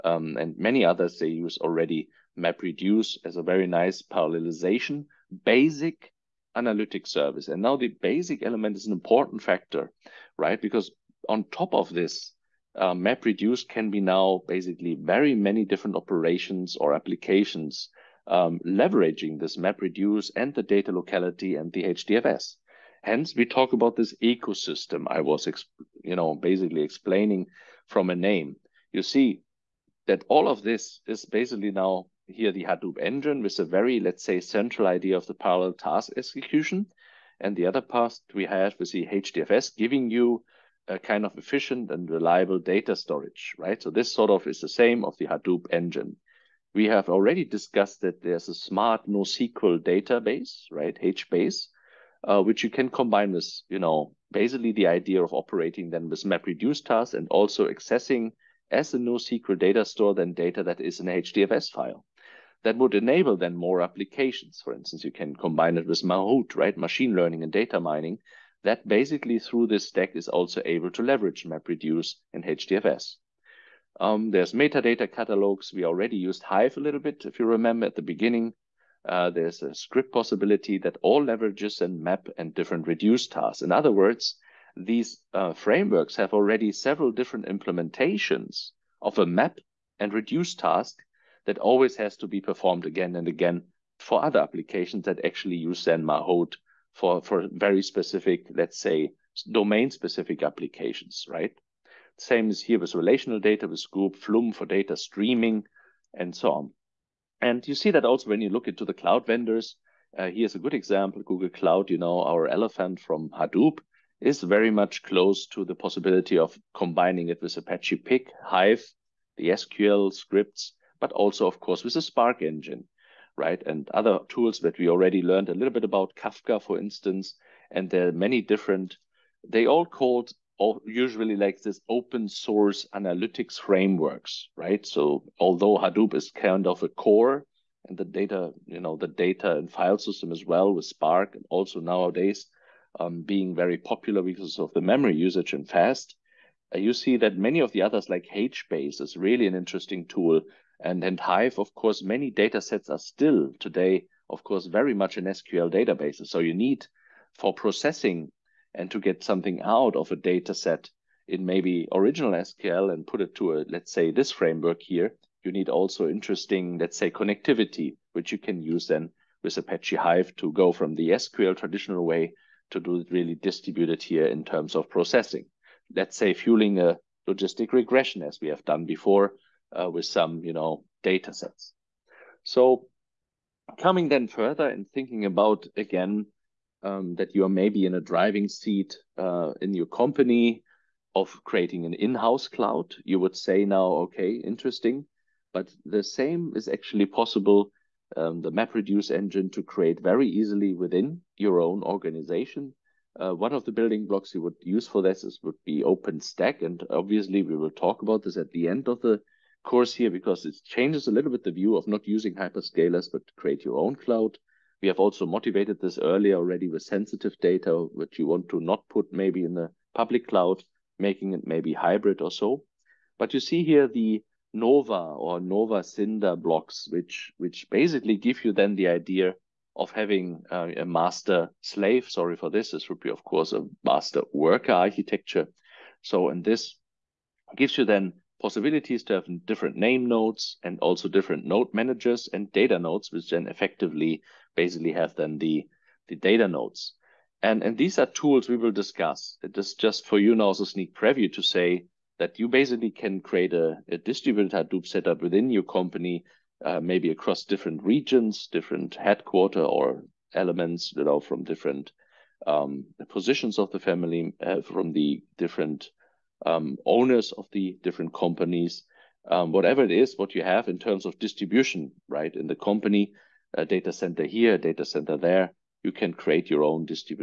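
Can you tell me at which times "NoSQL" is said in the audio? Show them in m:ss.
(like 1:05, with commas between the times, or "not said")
0:49, 0:58.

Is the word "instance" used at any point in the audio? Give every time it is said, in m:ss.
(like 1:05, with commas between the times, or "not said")
1:04, 2:06.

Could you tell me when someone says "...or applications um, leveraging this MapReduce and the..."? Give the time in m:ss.
0:16.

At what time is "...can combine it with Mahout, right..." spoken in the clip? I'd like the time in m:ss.
1:05.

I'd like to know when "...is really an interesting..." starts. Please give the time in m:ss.
2:29.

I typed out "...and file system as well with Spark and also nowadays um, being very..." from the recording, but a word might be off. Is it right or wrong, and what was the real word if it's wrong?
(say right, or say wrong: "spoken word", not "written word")
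right.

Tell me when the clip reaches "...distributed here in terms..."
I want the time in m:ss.
2:53.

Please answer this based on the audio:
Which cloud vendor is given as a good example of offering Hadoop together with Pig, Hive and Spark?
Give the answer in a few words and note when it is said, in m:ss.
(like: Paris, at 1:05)
Google Cloud, at 1:51.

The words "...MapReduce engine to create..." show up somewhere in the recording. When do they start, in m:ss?
3:18.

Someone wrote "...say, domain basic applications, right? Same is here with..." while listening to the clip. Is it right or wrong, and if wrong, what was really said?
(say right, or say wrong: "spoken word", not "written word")
wrong: "specific", not "basic".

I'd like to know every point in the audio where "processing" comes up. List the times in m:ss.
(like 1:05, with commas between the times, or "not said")
2:37, 2:54.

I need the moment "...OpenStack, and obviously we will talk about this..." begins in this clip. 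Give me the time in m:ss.
3:25.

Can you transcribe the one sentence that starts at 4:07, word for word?
And, and these are tools we will discuss.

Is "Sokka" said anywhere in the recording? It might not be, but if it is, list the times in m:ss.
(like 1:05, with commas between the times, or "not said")
not said.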